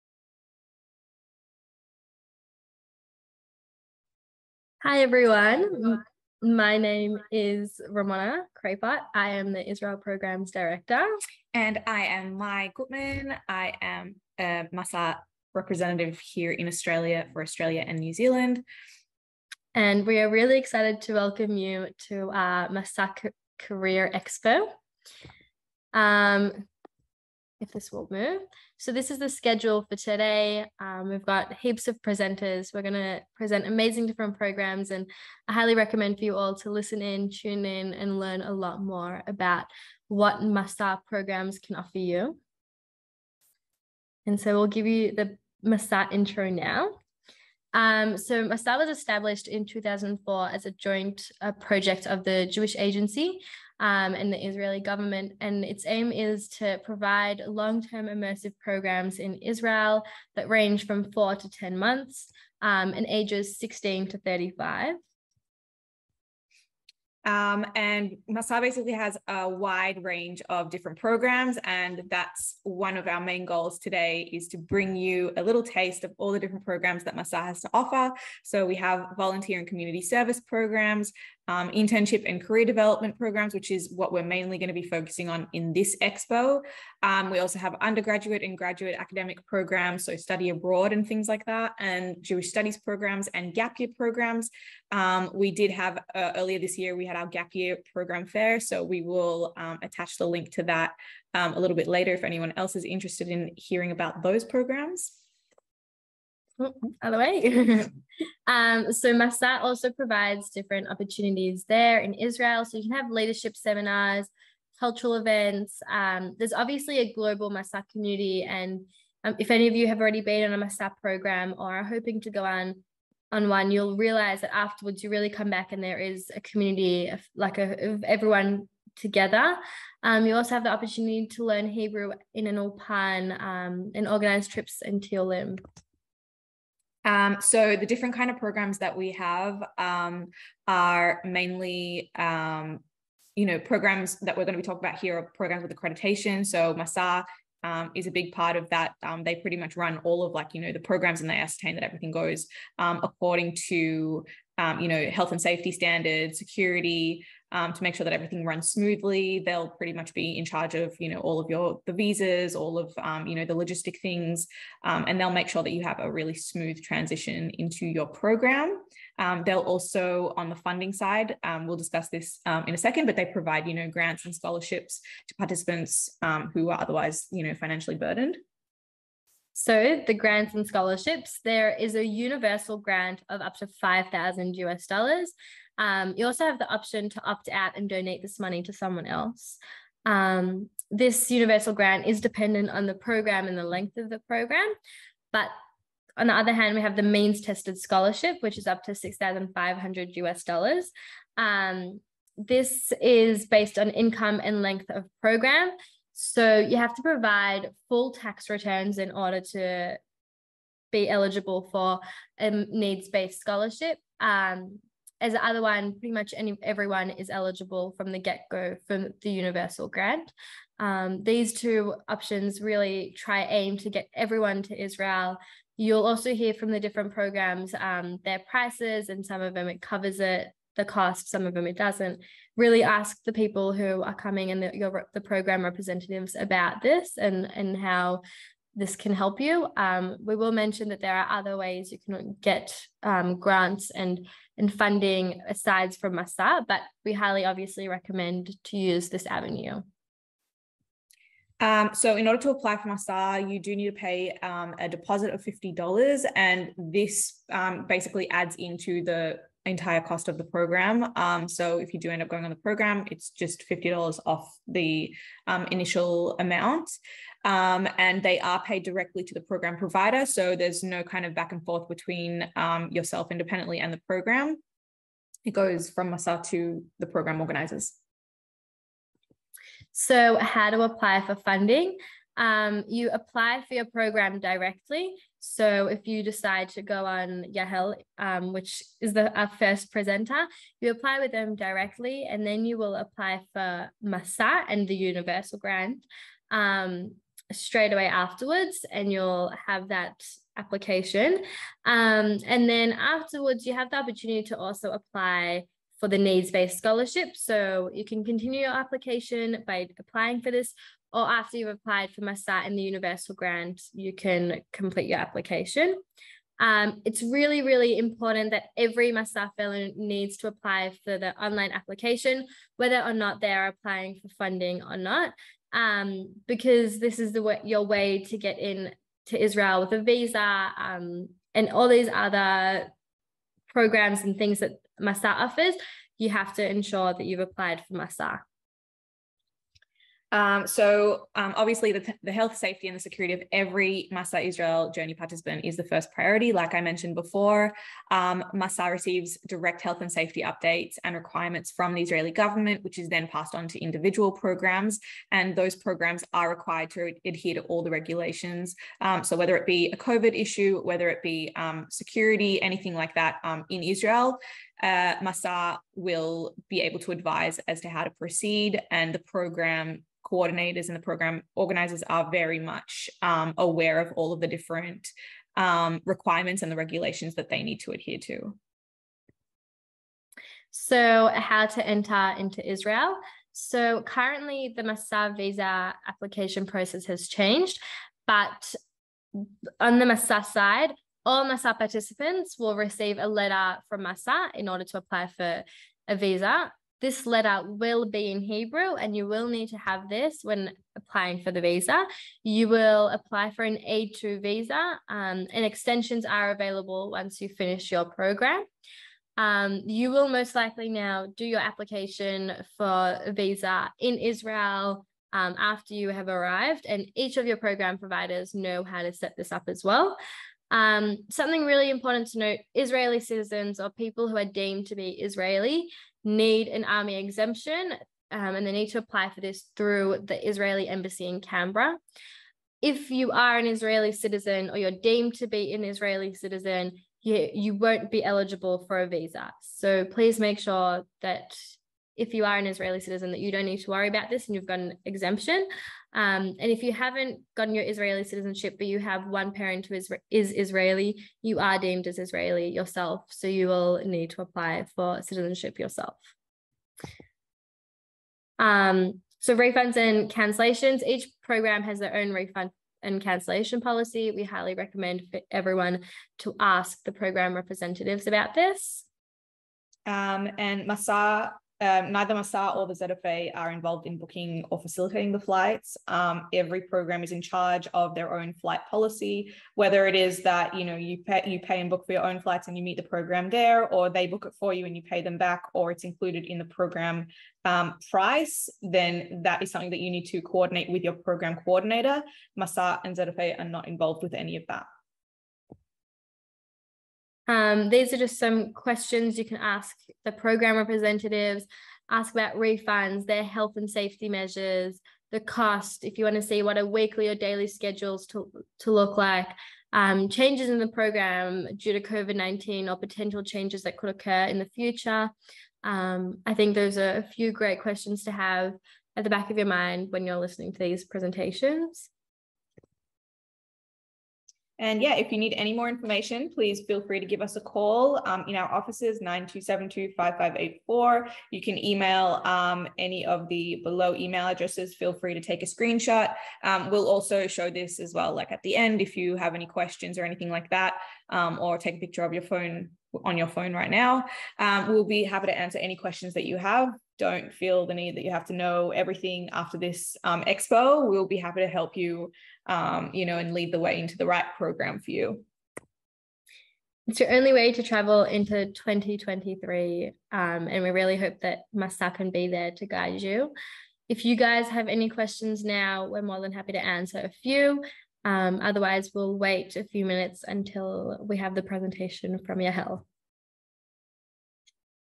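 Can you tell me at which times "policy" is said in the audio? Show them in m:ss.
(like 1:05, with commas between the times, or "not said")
7:43, 7:58.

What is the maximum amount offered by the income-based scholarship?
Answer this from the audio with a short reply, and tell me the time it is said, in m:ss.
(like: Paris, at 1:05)
6,500 US dollars, at 3:18.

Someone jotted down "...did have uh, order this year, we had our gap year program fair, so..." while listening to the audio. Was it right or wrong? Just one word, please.
wrong.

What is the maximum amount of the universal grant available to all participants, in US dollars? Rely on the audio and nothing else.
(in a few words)
5,000 US dollars.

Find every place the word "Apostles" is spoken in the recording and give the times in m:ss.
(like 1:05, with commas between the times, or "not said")
not said.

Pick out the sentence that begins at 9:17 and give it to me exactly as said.
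It's your only way to travel into 2023.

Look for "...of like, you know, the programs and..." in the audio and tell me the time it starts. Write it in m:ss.
2:30.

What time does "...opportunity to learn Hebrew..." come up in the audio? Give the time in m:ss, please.
2:10.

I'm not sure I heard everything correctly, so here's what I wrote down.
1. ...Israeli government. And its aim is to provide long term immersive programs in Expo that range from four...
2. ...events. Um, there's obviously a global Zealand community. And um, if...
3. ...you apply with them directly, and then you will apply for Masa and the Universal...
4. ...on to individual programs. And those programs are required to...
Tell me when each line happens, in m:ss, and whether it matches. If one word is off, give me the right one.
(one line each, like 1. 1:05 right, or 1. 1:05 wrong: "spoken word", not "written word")
1. 0:54 wrong: "Israel", not "Expo"
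2. 1:55 wrong: "Masa", not "Zealand"
3. 4:50 right
4. 5:53 right.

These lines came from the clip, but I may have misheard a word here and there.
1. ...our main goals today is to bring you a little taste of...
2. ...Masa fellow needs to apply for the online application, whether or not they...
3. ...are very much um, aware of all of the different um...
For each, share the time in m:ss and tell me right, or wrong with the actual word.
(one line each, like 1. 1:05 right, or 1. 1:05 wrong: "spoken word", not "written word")
1. 1:13 right
2. 5:19 right
3. 6:12 right.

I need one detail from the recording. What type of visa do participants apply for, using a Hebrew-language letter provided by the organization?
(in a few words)
A2 visa.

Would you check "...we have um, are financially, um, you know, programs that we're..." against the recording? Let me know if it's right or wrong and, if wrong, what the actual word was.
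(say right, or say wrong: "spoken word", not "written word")
wrong: "mainly", not "financially".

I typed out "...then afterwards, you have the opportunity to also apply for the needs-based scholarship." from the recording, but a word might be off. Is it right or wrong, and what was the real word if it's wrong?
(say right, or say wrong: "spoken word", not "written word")
right.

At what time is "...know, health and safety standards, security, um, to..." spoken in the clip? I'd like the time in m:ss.
2:34.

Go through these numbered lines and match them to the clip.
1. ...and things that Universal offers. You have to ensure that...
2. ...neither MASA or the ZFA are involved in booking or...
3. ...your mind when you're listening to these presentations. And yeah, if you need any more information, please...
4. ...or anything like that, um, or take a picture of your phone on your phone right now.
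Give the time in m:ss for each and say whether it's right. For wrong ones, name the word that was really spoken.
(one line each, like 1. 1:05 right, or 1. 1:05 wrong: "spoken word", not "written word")
1. 5:34 wrong: "Masa", not "Universal"
2. 7:52 right
3. 8:39 right
4. 9:00 right.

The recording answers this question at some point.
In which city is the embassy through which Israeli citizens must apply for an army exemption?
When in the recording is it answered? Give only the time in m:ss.
7:11.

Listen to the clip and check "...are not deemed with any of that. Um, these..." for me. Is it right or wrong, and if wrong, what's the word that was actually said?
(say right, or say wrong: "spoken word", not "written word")
wrong: "involved", not "deemed".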